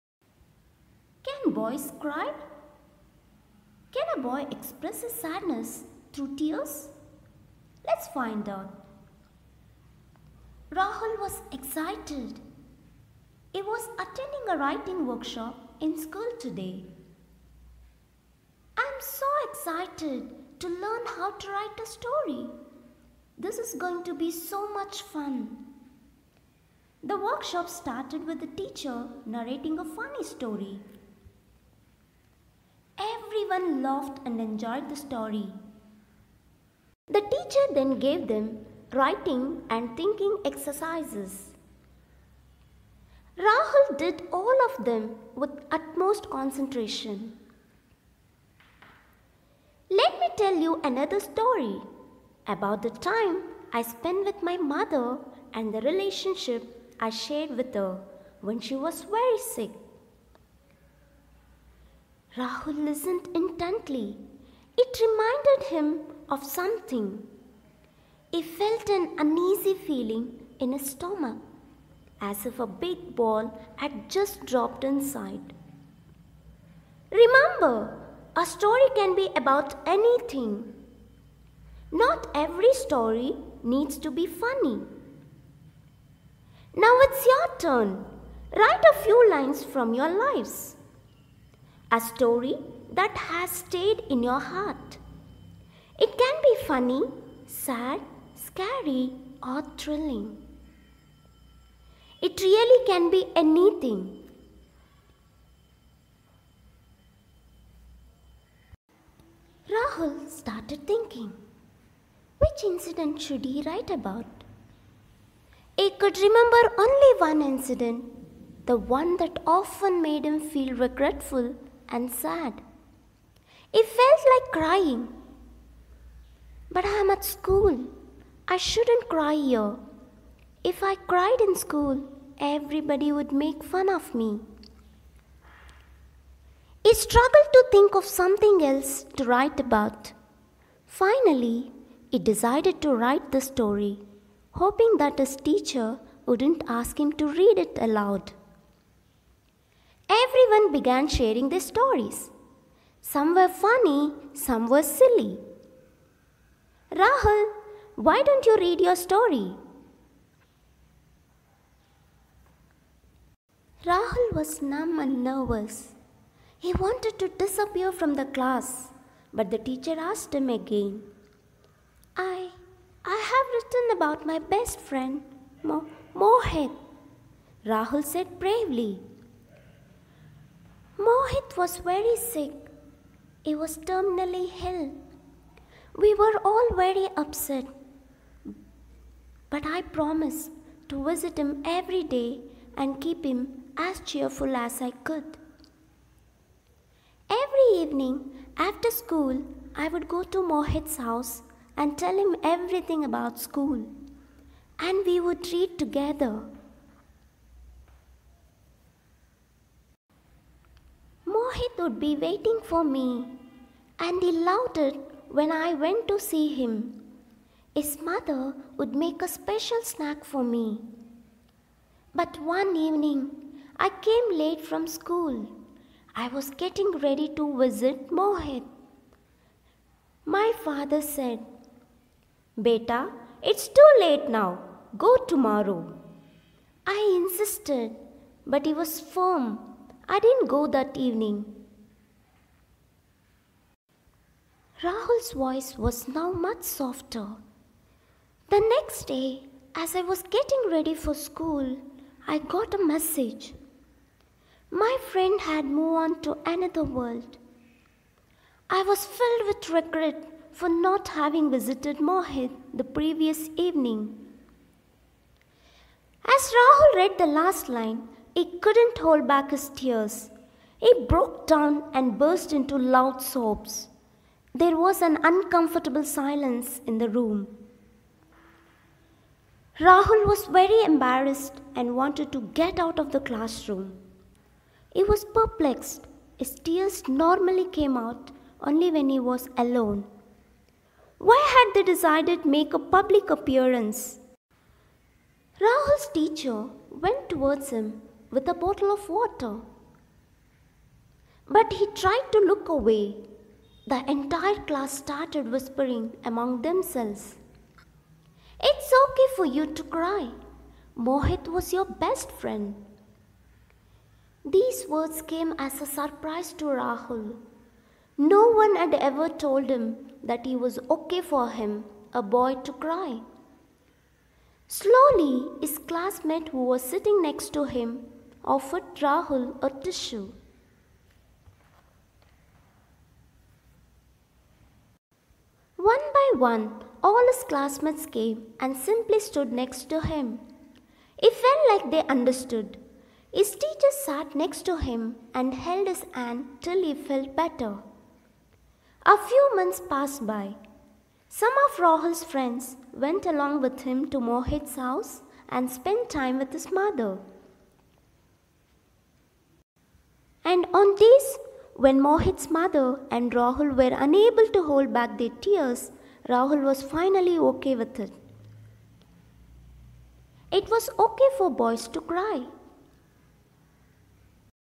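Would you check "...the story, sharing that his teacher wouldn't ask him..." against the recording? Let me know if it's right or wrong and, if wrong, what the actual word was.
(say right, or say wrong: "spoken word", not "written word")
wrong: "hoping", not "sharing".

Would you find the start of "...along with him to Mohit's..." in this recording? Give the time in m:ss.
5:53.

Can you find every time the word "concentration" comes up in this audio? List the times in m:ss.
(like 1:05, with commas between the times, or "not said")
0:46.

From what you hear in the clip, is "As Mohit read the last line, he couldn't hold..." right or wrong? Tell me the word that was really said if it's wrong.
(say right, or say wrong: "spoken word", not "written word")
wrong: "Rahul", not "Mohit".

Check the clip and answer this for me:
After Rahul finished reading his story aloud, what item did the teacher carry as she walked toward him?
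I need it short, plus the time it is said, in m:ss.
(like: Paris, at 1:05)
A bottle of water, at 4:58.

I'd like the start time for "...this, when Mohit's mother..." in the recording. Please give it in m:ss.
6:00.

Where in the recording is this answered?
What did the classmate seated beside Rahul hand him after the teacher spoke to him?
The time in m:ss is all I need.
5:29.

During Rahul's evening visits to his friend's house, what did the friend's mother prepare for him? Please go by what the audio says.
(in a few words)
A special snack.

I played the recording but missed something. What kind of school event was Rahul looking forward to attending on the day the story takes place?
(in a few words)
Writing workshop.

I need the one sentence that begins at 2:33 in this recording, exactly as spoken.
Some were funny, some were silly.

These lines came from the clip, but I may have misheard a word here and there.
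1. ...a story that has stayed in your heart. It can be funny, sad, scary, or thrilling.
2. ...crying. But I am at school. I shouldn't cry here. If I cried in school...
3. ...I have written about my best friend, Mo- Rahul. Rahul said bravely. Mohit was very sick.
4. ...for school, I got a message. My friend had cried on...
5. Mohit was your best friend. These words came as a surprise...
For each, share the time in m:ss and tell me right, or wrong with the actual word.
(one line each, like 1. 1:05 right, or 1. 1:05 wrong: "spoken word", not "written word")
1. 1:31 right
2. 2:04 right
3. 2:53 wrong: "Mohit", not "Rahul"
4. 4:10 wrong: "moved", not "cried"
5. 5:10 right.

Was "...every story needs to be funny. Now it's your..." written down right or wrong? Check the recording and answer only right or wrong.
right.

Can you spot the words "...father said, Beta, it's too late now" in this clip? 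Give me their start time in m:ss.
3:50.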